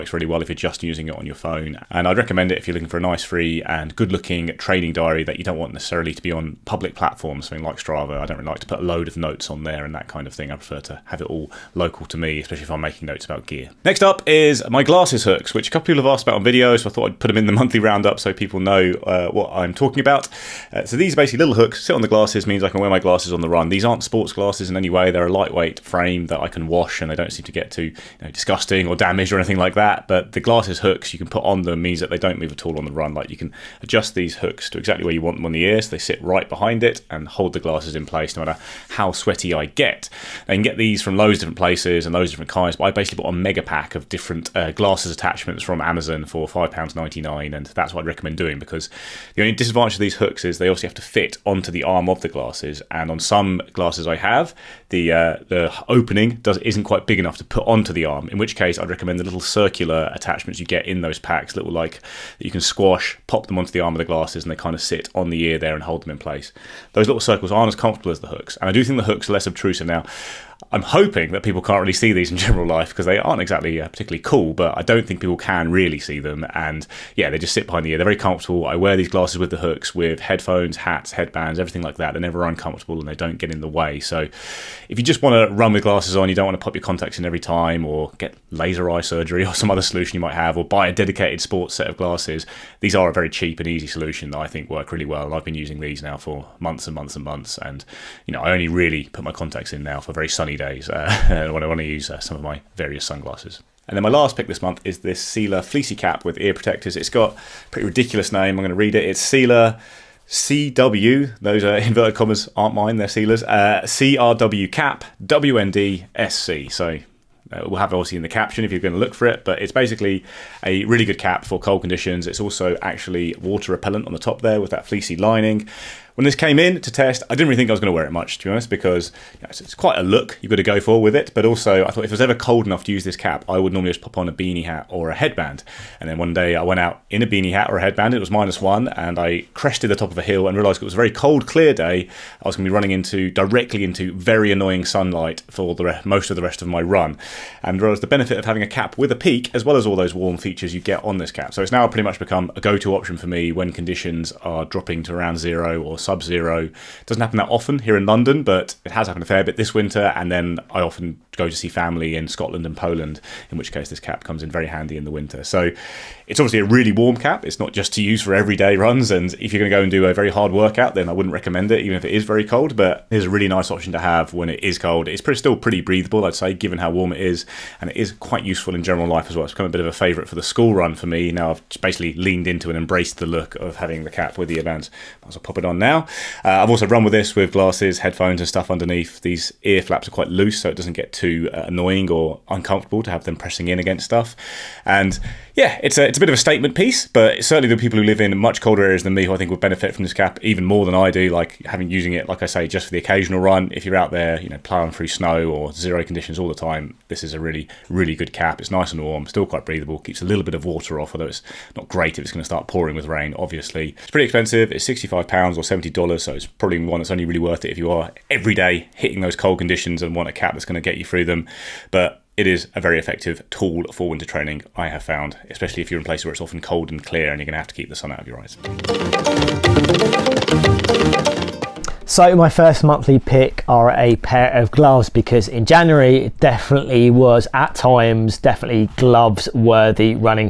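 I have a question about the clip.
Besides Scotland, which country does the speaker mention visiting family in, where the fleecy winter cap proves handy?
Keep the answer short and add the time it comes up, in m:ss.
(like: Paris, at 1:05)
Poland, at 2:42.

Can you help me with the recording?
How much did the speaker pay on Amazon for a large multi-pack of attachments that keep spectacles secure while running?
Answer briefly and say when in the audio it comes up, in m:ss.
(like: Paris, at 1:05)
£5.99, at 0:46.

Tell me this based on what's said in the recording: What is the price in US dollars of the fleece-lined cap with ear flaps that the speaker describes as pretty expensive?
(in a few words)
$70.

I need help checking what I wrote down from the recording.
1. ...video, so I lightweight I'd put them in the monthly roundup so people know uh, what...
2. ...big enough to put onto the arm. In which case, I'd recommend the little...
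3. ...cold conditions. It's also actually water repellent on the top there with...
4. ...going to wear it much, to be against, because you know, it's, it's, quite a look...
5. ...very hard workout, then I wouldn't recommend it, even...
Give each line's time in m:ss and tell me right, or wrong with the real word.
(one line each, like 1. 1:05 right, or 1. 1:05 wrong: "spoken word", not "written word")
1. 0:16 wrong: "thought", not "lightweight"
2. 0:57 right
3. 2:01 right
4. 2:07 wrong: "honest", not "against"
5. 2:50 right.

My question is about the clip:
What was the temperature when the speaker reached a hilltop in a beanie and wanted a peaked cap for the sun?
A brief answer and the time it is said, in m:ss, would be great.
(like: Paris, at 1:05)
-1, at 2:18.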